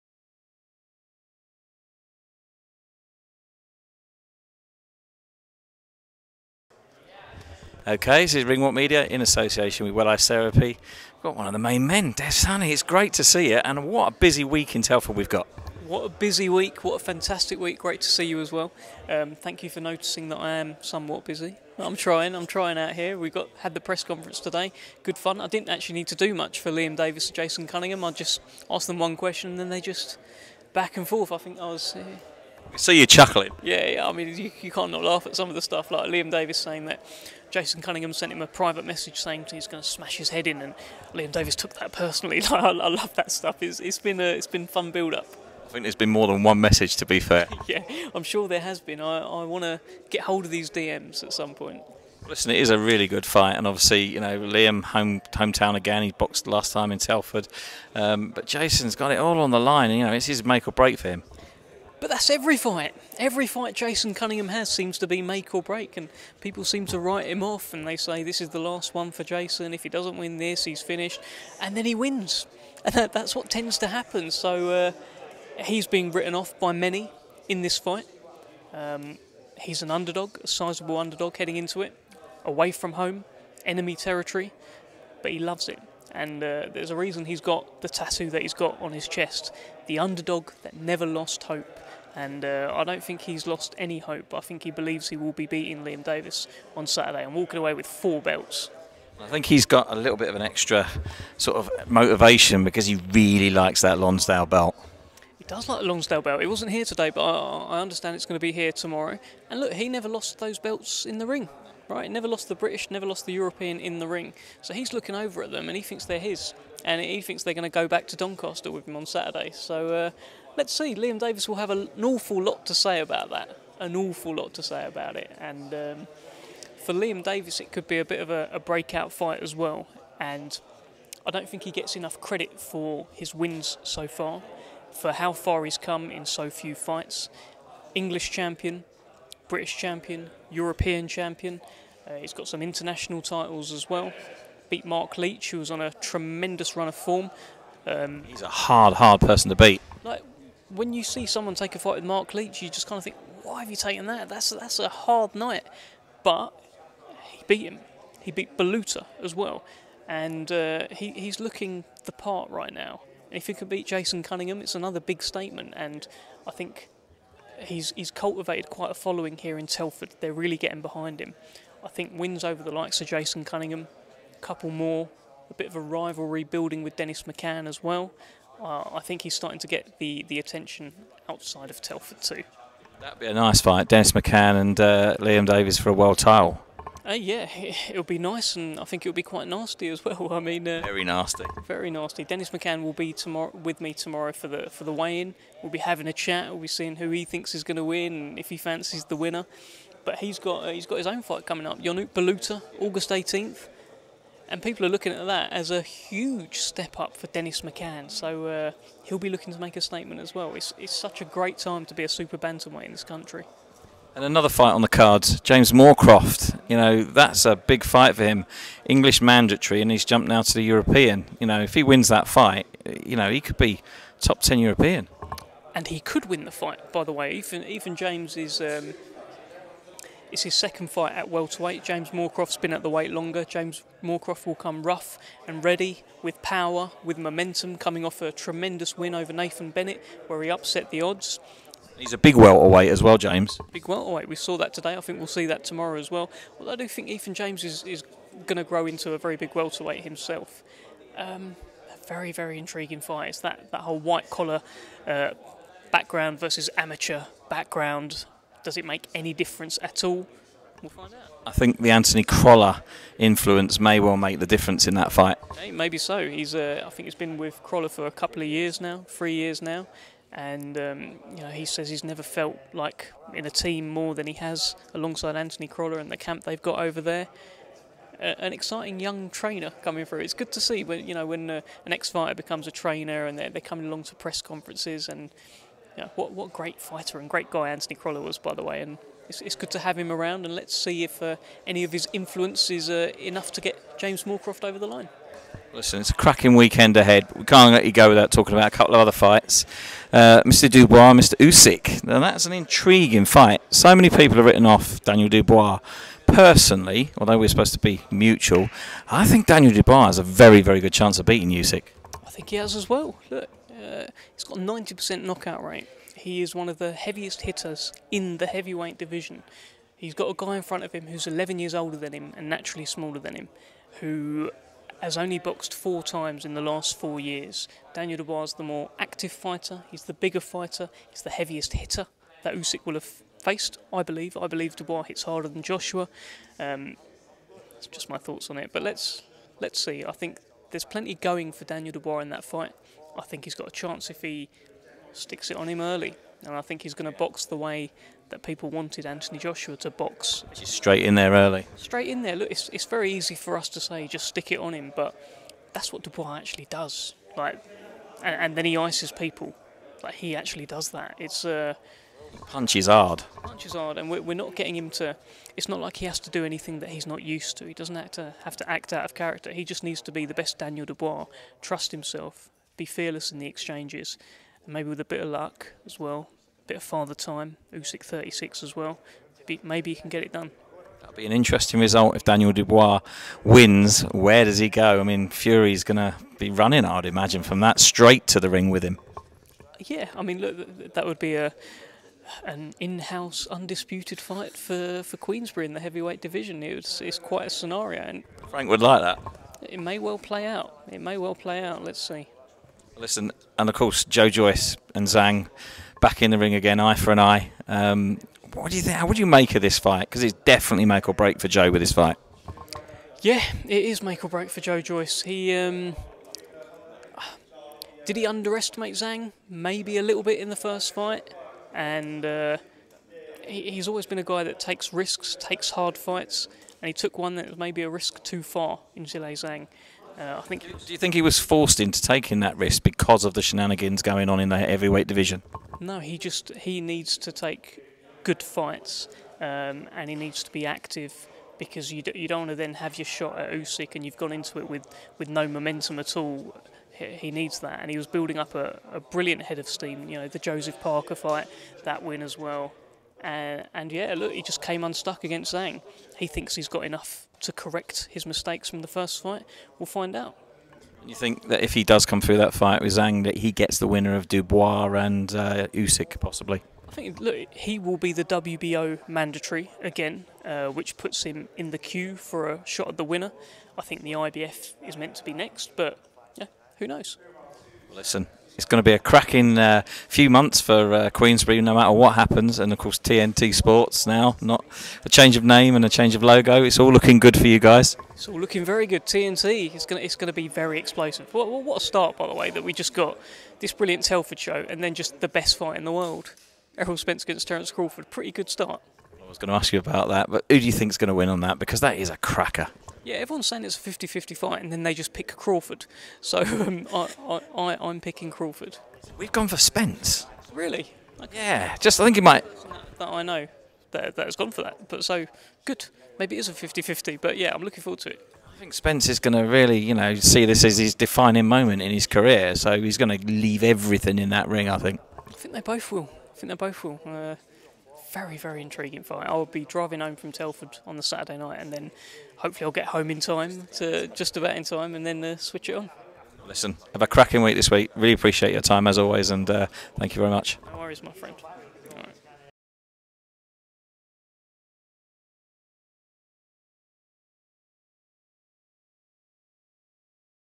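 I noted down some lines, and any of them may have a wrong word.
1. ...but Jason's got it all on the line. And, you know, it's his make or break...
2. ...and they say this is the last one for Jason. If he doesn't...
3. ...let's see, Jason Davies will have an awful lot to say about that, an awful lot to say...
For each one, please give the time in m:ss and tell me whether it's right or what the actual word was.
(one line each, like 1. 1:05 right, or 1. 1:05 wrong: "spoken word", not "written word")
1. 0:58 right
2. 1:07 right
3. 2:00 wrong: "Liam", not "Jason".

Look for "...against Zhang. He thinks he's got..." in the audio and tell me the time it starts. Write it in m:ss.
7:35.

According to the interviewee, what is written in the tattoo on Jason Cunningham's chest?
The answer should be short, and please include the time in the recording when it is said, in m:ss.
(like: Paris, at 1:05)
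The underdog that never lost hope, at 1:29.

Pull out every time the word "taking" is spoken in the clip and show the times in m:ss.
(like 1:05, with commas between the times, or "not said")
7:12.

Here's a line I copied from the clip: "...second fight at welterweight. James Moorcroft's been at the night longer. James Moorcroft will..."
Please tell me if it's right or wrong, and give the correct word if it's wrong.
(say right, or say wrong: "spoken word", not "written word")
wrong: "weight", not "night".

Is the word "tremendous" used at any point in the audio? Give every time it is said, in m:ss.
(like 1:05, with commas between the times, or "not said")
2:25, 3:58.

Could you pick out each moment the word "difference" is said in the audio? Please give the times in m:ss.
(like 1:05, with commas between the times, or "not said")
4:19, 4:24.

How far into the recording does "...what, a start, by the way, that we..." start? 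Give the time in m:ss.
8:11.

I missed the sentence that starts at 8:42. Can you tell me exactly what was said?
So he's going to leave everything in that ring, I think.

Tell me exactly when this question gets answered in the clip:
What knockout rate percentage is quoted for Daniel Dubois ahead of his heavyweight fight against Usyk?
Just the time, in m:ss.
5:14.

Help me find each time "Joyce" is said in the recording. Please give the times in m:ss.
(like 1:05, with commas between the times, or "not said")
6:44, 6:54.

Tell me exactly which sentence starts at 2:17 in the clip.
English champion, British champion, European champion.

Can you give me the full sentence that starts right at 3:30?
It's, it's such a great time to be a super bantamweight in this country.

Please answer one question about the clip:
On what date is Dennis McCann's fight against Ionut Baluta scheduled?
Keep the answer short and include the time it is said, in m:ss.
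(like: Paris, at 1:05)
August 18th, at 3:22.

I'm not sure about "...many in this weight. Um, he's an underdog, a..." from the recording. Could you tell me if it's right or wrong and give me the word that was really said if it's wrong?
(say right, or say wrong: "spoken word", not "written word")
wrong: "fight", not "weight".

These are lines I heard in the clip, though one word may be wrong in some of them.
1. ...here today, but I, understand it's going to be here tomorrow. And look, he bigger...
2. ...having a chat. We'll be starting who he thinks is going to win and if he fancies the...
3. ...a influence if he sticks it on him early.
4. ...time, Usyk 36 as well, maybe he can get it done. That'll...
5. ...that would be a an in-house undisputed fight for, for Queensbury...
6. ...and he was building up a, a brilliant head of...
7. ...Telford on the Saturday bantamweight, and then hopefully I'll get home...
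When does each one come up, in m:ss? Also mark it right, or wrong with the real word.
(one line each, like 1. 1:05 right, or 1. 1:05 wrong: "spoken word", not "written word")
1. 1:46 wrong: "never", not "bigger"
2. 3:15 wrong: "seeing", not "starting"
3. 5:43 wrong: "chance", not "influence"
4. 6:17 right
5. 6:30 right
6. 7:27 right
7. 8:50 wrong: "night", not "bantamweight".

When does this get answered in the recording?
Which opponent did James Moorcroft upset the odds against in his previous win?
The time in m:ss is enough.
3:59.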